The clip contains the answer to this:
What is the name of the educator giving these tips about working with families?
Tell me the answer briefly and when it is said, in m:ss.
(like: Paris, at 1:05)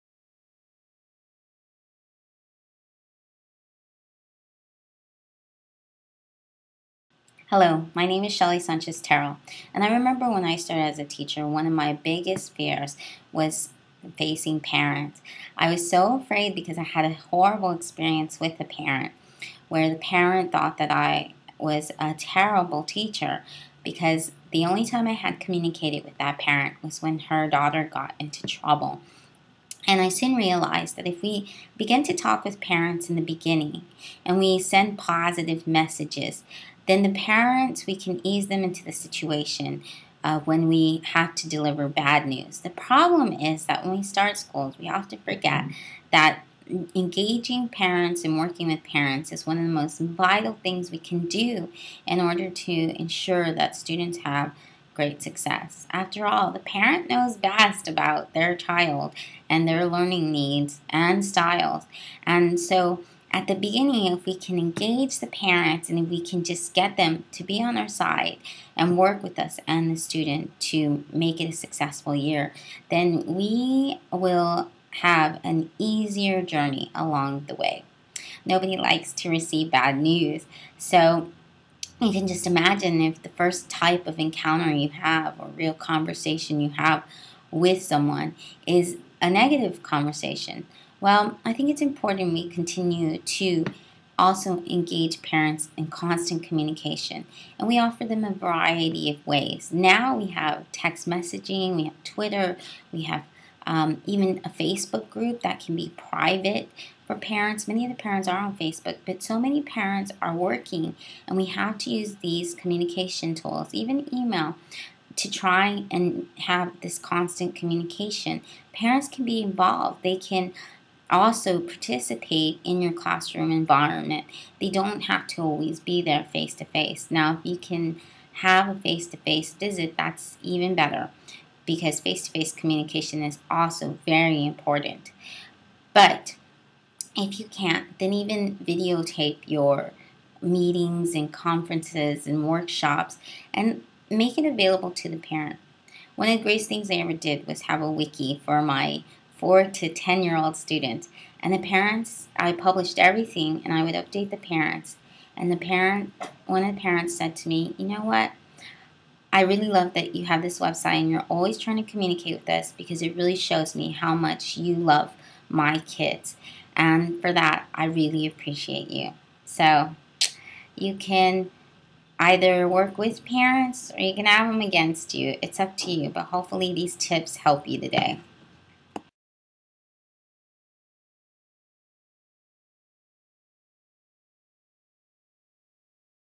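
Shelly Sanchez Terrell, at 0:08.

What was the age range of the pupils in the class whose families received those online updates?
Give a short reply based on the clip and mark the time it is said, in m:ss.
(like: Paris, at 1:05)
4 to 10, at 2:29.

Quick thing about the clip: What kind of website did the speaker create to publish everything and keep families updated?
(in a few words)
A wiki.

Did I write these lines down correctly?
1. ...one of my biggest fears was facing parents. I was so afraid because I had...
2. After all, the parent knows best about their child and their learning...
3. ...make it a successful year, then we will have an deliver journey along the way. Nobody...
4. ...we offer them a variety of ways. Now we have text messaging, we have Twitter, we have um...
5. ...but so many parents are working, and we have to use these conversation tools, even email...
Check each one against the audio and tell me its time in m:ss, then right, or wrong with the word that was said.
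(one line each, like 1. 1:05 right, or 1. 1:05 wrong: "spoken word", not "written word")
1. 0:11 right
2. 0:55 right
3. 1:11 wrong: "easier", not "deliver"
4. 1:37 right
5. 1:49 wrong: "communication", not "conversation".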